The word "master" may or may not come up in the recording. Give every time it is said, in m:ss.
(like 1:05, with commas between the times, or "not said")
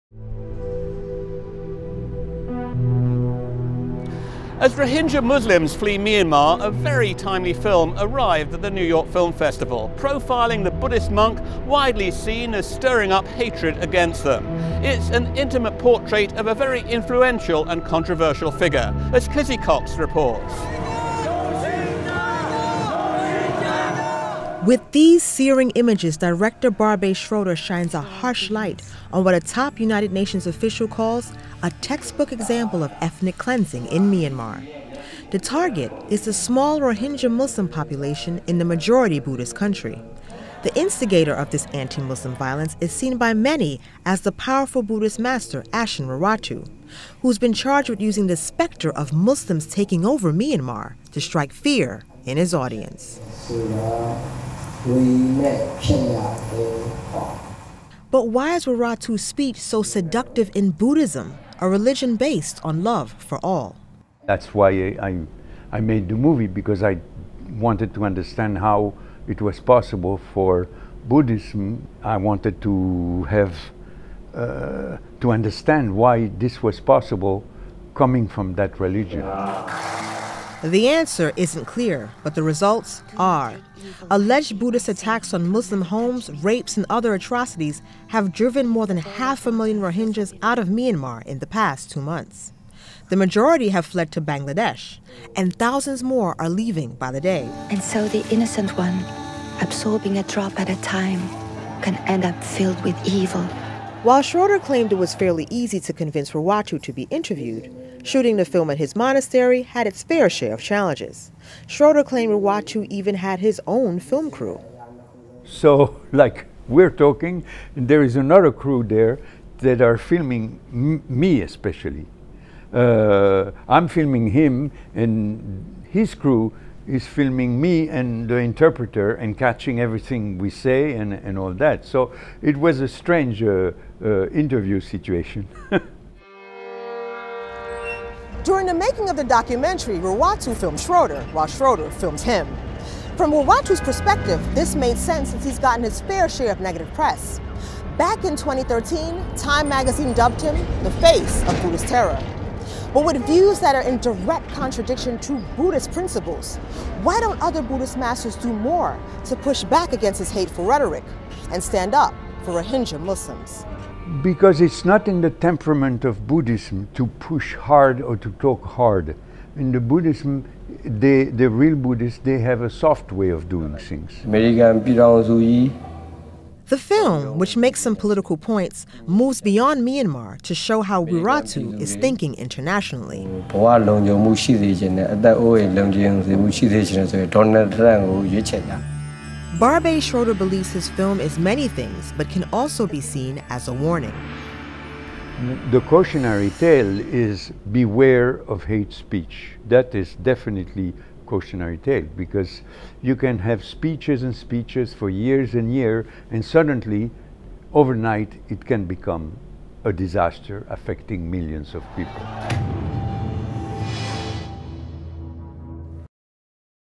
0:45, 2:37.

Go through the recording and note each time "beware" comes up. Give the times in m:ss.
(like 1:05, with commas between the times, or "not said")
3:17.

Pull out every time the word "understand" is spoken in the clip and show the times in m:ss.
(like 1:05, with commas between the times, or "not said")
1:08, 1:15.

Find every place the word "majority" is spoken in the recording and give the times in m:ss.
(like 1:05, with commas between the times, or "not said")
0:38, 1:33.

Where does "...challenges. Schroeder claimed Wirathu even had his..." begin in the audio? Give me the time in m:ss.
1:50.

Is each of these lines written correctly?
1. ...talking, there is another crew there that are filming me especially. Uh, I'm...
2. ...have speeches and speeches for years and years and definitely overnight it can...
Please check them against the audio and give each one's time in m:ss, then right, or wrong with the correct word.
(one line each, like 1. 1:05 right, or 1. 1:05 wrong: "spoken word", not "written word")
1. 1:56 right
2. 3:23 wrong: "suddenly", not "definitely".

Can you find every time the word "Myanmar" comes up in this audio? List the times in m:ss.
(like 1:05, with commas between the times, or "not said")
0:05, 0:34, 0:50, 1:30, 2:59.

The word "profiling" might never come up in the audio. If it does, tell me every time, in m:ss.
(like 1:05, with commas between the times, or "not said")
0:09.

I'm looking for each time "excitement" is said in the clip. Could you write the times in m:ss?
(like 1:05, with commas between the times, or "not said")
not said.